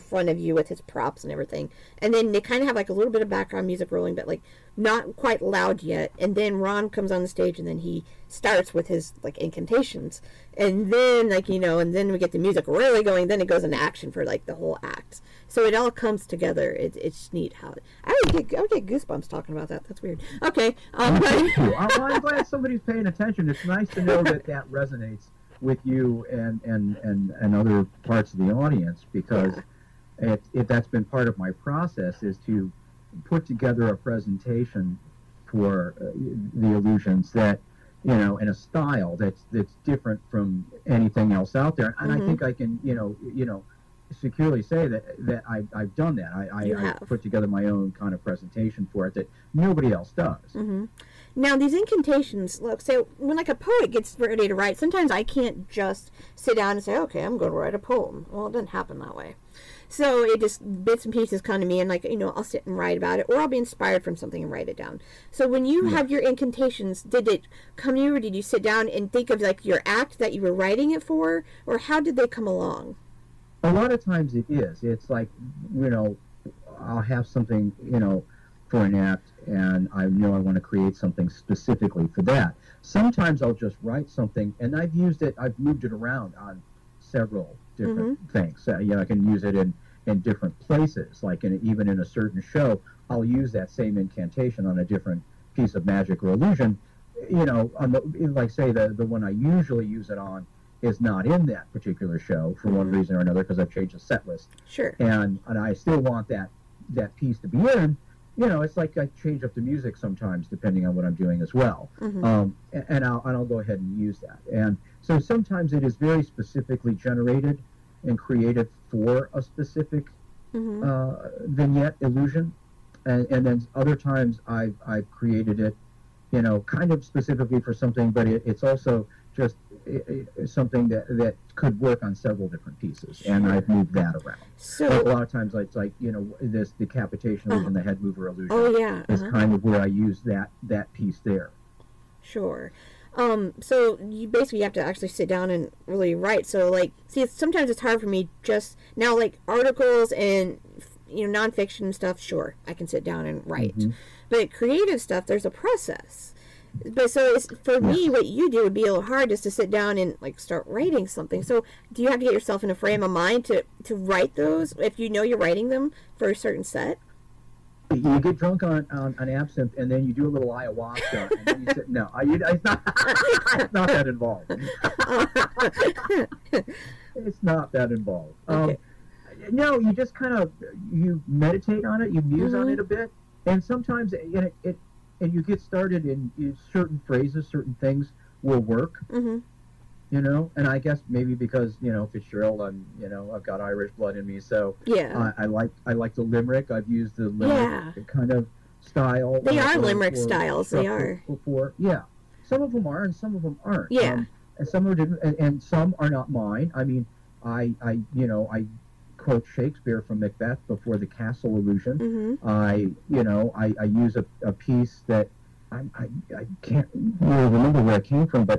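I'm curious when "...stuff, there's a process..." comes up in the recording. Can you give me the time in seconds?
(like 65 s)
155 s.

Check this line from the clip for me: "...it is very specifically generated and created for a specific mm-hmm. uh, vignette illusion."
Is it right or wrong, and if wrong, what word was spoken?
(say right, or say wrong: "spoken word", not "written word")
right.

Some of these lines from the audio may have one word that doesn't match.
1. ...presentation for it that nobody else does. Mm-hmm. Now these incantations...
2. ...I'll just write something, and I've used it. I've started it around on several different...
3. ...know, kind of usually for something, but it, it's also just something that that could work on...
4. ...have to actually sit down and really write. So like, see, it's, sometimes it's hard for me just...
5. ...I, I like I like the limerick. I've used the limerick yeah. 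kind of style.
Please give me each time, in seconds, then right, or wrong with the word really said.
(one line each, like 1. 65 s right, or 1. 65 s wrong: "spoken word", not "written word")
1. 48 s right
2. 83 s wrong: "moved", not "started"
3. 126 s wrong: "specifically", not "usually"
4. 144 s right
5. 195 s right.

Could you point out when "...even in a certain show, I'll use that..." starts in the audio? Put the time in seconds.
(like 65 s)
91 s.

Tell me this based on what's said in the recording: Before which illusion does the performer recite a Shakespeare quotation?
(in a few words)
castle illusion.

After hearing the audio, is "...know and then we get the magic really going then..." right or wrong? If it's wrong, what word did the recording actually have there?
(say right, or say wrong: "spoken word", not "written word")
wrong: "music", not "magic".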